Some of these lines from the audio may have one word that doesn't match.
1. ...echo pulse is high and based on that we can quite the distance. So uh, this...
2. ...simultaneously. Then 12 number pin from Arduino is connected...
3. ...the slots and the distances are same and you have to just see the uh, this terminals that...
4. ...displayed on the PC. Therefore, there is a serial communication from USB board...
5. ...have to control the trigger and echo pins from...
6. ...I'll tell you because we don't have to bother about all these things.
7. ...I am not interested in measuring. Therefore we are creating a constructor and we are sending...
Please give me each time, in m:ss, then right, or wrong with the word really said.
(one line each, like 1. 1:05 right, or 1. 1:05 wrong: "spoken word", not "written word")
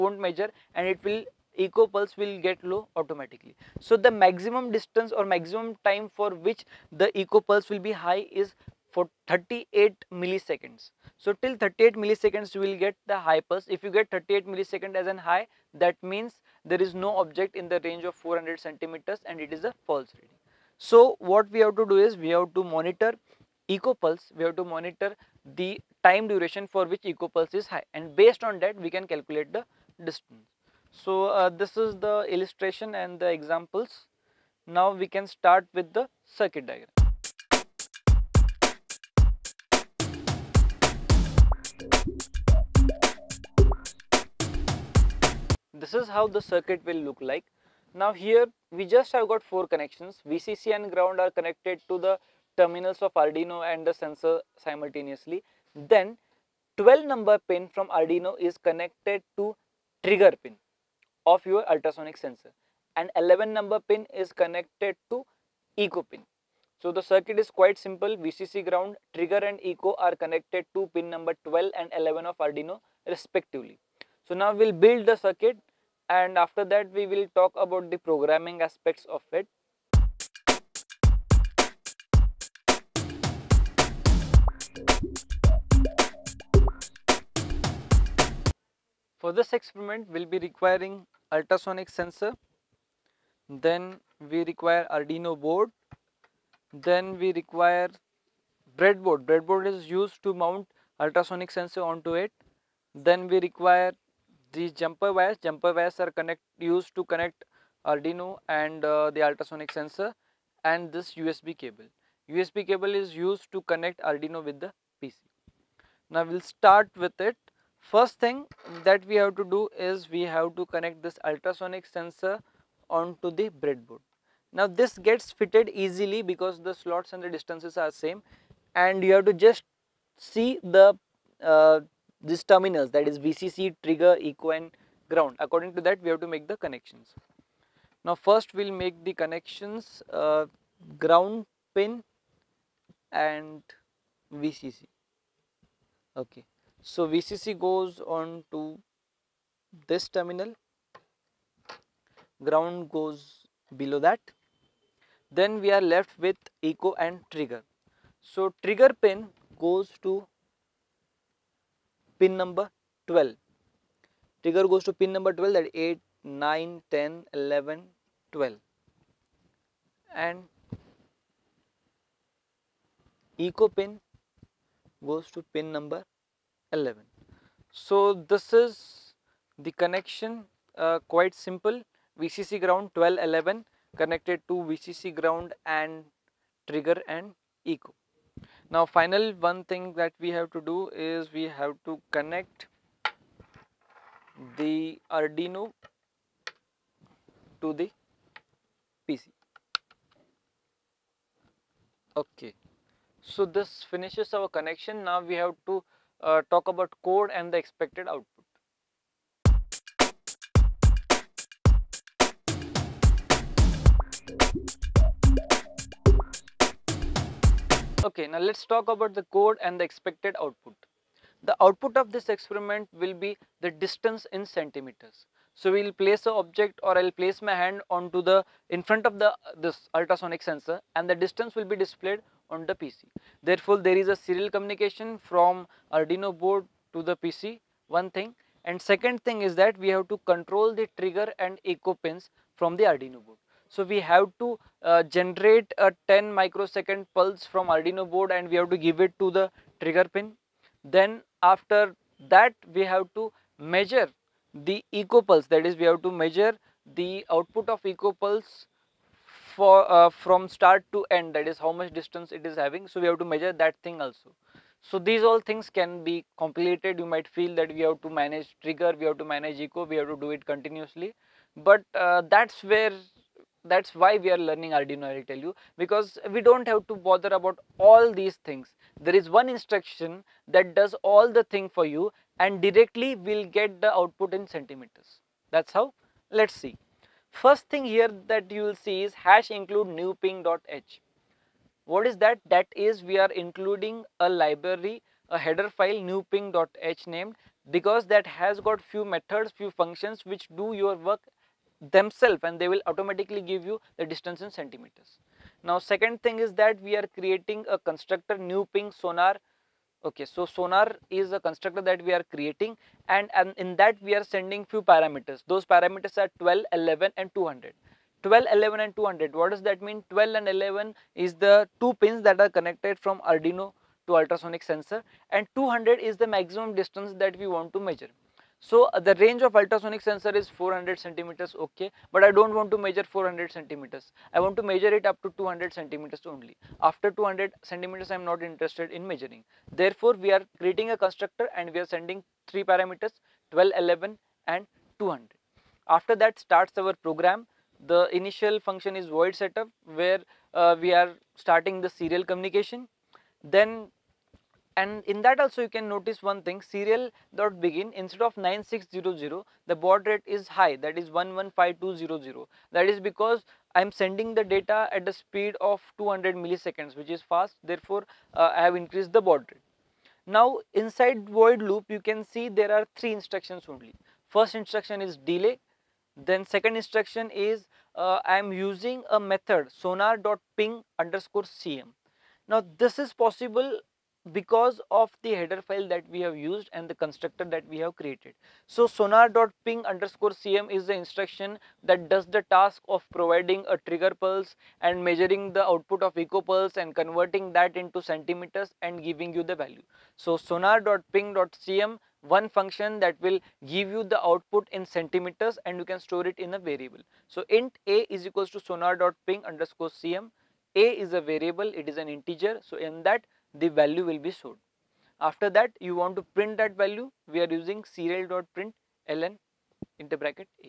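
1. 0:27 wrong: "calculate", not "quite"
2. 0:54 right
3. 2:06 right
4. 3:51 wrong: "Arduino", not "USB"
5. 3:59 right
6. 4:35 right
7. 5:38 right.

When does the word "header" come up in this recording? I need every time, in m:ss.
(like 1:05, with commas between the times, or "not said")
4:55, 6:25.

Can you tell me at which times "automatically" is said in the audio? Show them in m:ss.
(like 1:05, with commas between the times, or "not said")
0:02, 5:02.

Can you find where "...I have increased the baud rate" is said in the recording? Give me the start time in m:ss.
6:08.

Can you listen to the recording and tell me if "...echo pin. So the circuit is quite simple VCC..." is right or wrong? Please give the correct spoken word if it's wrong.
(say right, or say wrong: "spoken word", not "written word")
right.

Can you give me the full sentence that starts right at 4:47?
First thing here that you will see is hash include new ping.h.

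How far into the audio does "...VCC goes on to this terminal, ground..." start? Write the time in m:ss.
2:27.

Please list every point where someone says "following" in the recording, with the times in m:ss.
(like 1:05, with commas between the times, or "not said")
not said.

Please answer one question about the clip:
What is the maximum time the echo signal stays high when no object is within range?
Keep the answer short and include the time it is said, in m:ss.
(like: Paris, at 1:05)
38 milliseconds, at 0:09.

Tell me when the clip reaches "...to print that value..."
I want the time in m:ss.
6:56.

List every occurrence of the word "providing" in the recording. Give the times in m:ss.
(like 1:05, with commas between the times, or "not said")
6:33.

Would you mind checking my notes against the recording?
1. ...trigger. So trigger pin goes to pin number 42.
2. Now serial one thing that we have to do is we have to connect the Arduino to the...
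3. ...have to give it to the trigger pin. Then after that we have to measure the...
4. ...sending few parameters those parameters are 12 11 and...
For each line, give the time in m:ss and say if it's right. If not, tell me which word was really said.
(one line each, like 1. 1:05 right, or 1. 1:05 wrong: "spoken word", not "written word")
1. 2:37 wrong: "12", not "42"
2. 3:08 wrong: "final", not "serial"
3. 4:08 right
4. 5:14 right.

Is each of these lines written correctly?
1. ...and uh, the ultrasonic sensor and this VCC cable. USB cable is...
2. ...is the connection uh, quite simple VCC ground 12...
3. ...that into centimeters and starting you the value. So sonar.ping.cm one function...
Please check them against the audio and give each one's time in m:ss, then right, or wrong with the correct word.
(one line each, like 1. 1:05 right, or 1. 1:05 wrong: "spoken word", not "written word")
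1. 1:48 wrong: "USB", not "VCC"
2. 2:58 right
3. 6:37 wrong: "giving", not "starting".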